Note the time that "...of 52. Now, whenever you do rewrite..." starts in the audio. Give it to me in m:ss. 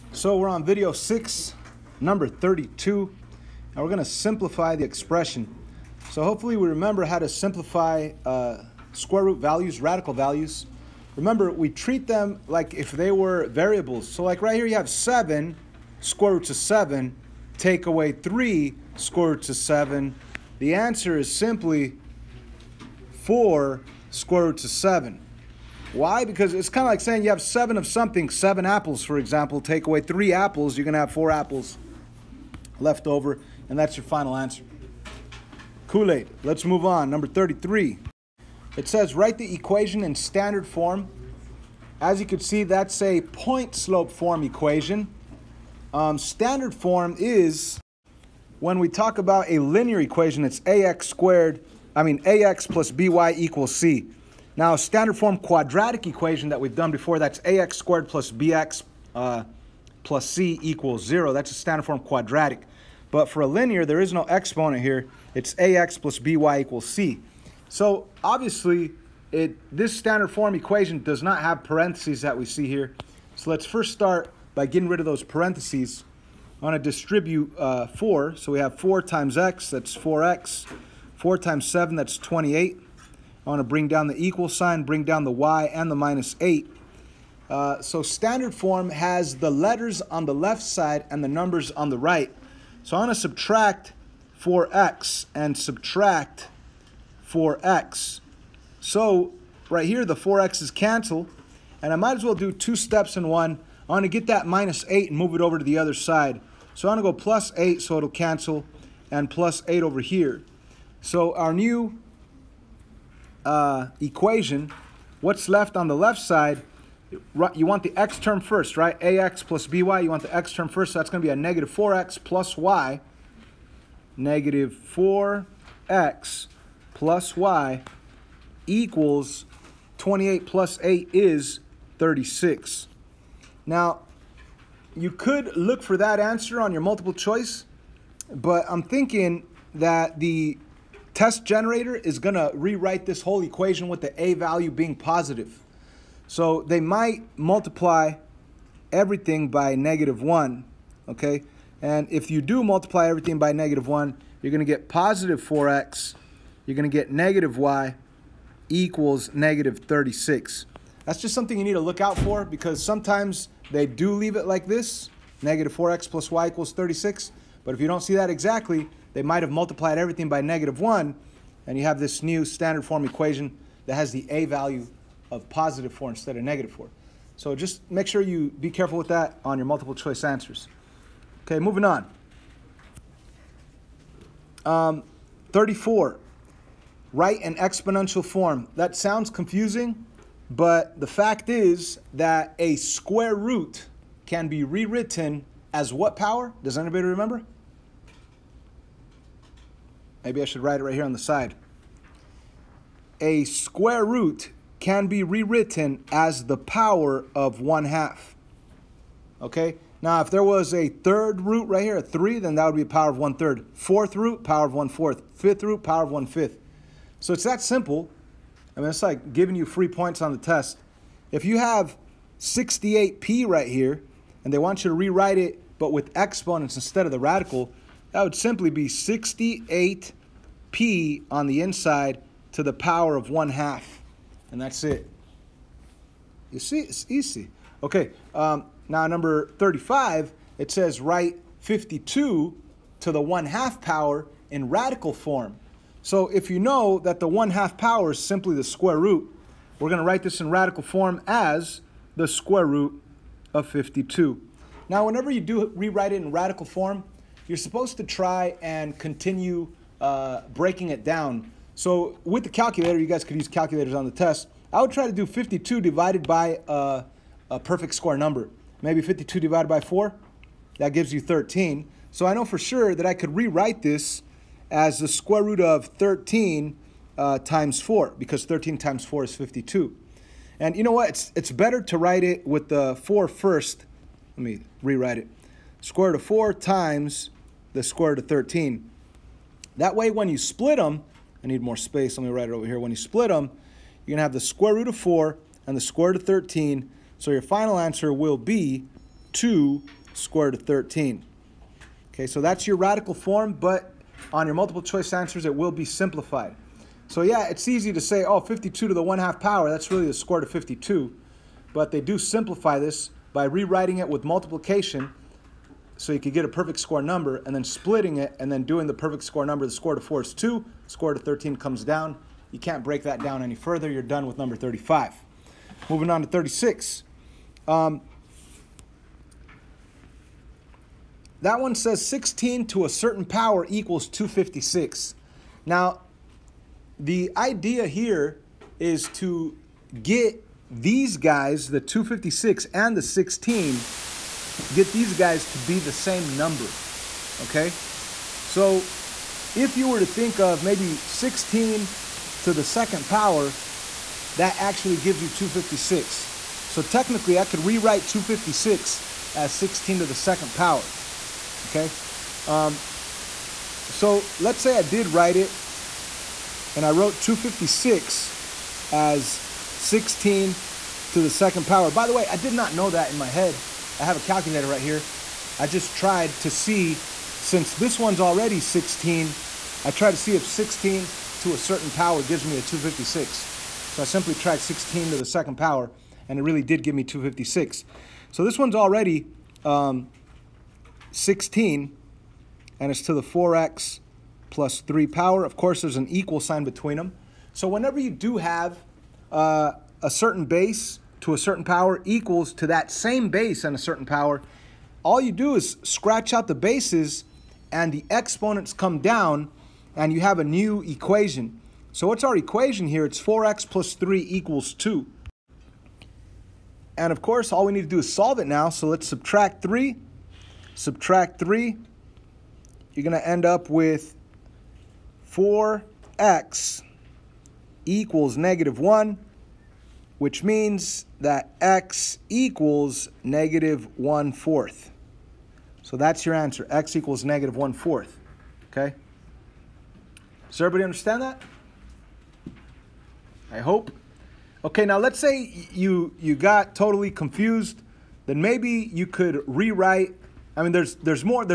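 4:13.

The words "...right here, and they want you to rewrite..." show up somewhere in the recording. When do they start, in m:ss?
3:43.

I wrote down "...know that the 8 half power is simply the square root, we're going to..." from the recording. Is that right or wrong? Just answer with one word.
wrong.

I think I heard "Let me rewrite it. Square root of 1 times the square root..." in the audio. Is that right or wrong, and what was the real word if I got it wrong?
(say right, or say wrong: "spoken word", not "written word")
wrong: "4", not "1".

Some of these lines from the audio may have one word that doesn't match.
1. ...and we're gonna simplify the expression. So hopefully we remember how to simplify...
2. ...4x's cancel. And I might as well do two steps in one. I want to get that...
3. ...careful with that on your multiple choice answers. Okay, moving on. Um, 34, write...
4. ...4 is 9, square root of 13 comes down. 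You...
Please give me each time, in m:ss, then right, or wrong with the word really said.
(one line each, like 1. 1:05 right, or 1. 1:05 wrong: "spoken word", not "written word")
1. 0:03 right
2. 1:40 right
3. 2:58 right
4. 5:20 wrong: "2", not "9".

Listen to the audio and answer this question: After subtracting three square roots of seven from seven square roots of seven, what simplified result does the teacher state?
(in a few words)
4 square root of 7.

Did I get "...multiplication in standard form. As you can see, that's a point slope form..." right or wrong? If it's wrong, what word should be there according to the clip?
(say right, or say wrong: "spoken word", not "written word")
wrong: "equation", not "multiplication".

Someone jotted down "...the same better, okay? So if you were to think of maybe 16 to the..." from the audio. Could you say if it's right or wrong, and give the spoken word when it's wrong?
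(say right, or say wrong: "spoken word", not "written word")
wrong: "number", not "better".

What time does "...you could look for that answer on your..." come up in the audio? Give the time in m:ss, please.
2:14.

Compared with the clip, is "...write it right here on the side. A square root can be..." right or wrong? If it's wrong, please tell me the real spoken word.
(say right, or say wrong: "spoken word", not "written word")
right.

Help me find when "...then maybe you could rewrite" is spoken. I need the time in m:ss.
7:28.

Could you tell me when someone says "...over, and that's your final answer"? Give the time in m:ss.
0:33.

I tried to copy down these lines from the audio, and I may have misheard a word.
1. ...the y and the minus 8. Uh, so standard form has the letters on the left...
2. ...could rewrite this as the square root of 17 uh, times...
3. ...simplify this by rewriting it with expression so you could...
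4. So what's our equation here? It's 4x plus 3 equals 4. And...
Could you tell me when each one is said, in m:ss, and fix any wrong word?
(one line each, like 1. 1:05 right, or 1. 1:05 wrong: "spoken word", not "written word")
1. 1:25 right
2. 4:33 wrong: "13", not "17"
3. 5:12 wrong: "multiplication", not "expression"
4. 6:51 wrong: "2", not "4".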